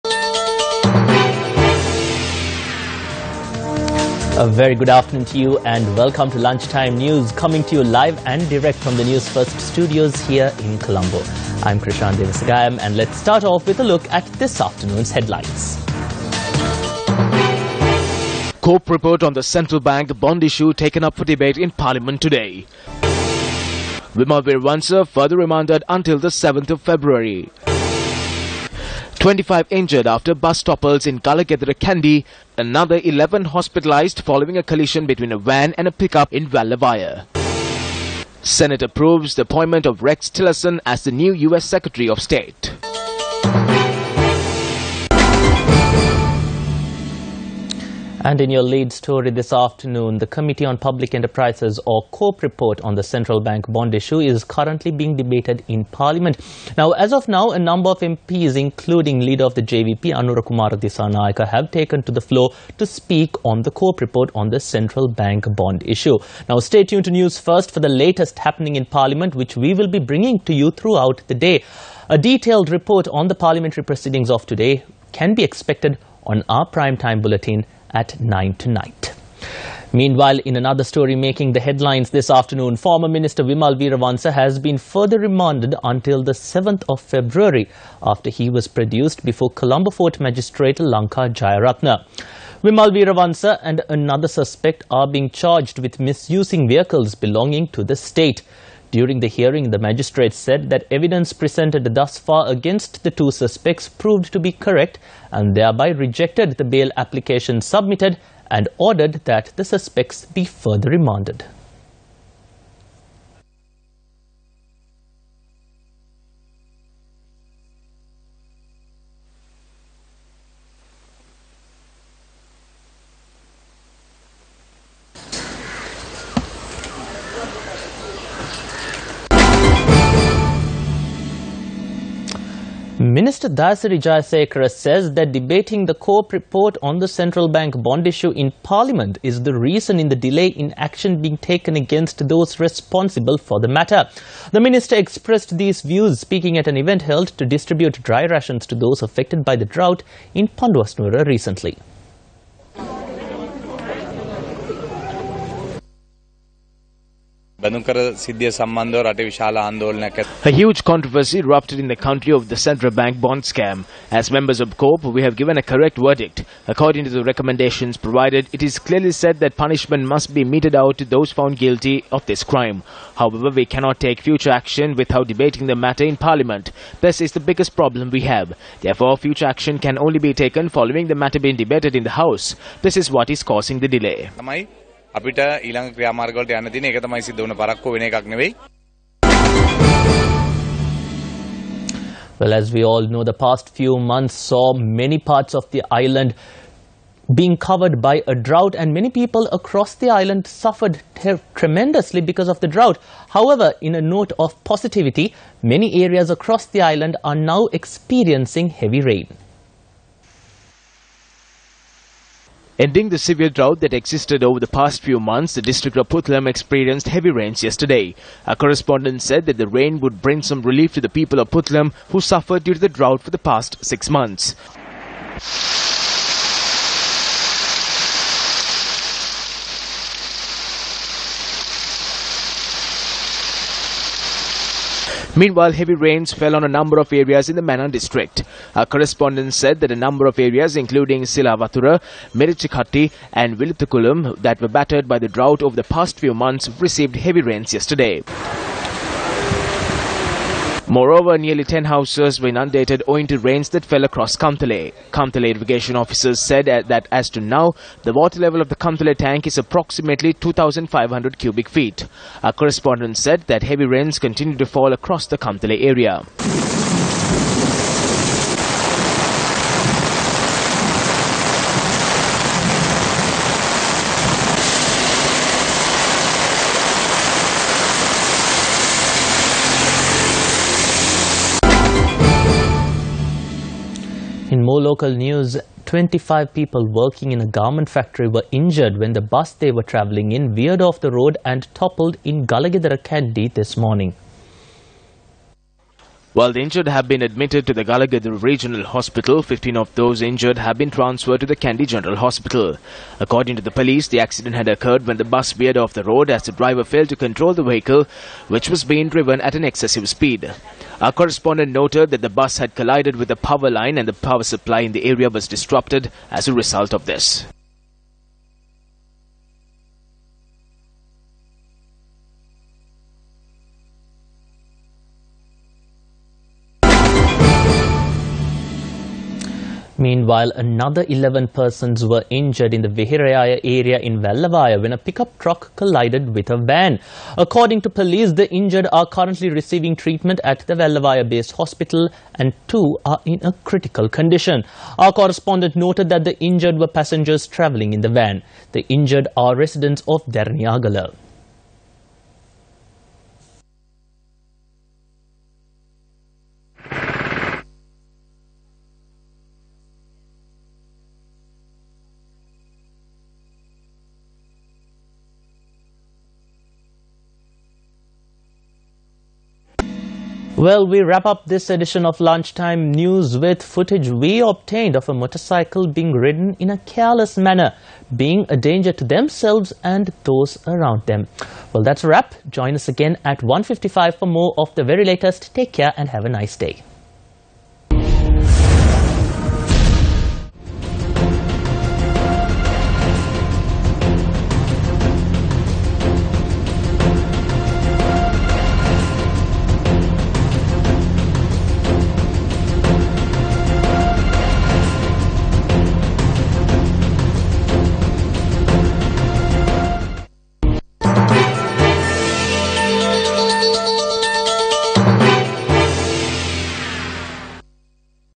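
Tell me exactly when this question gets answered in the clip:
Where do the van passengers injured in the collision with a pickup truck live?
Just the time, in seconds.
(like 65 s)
350 s.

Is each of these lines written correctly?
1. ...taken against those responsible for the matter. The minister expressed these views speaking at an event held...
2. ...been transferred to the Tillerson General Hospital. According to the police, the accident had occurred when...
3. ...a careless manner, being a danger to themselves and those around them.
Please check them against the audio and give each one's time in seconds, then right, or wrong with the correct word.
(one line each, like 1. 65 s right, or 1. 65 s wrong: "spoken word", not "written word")
1. 141 s right
2. 300 s wrong: "Kandy", not "Tillerson"
3. 376 s right.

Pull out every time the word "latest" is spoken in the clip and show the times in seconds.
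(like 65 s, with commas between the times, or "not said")
67 s, 385 s.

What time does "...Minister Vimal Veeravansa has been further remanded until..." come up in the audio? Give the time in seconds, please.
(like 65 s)
83 s.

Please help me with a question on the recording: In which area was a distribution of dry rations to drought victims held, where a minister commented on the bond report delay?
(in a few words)
Panduwasnuwara.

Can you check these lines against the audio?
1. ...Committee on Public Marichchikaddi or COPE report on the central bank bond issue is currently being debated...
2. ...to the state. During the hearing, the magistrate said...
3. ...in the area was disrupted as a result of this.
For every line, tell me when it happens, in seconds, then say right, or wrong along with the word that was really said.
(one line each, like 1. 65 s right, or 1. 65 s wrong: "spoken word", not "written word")
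1. 50 s wrong: "Enterprises", not "Marichchikaddi"
2. 97 s right
3. 314 s right.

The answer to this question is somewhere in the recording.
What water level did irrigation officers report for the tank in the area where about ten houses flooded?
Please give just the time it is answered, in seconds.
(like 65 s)
260 s.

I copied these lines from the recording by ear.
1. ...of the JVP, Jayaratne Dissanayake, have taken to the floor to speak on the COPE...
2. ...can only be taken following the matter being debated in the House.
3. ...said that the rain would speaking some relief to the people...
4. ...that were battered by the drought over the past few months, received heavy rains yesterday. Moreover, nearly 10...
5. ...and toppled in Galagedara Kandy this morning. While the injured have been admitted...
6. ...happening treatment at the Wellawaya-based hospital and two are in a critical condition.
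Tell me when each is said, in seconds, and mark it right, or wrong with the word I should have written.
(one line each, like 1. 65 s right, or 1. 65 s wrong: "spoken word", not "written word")
1. 59 s wrong: "Kumara", not "Jayaratne"
2. 179 s right
3. 219 s wrong: "bring", not "speaking"
4. 244 s right
5. 291 s right
6. 339 s wrong: "receiving", not "happening".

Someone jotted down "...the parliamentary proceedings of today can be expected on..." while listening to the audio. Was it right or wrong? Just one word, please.
right.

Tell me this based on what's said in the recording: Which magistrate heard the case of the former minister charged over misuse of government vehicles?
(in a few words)
Lanka Jayaratne.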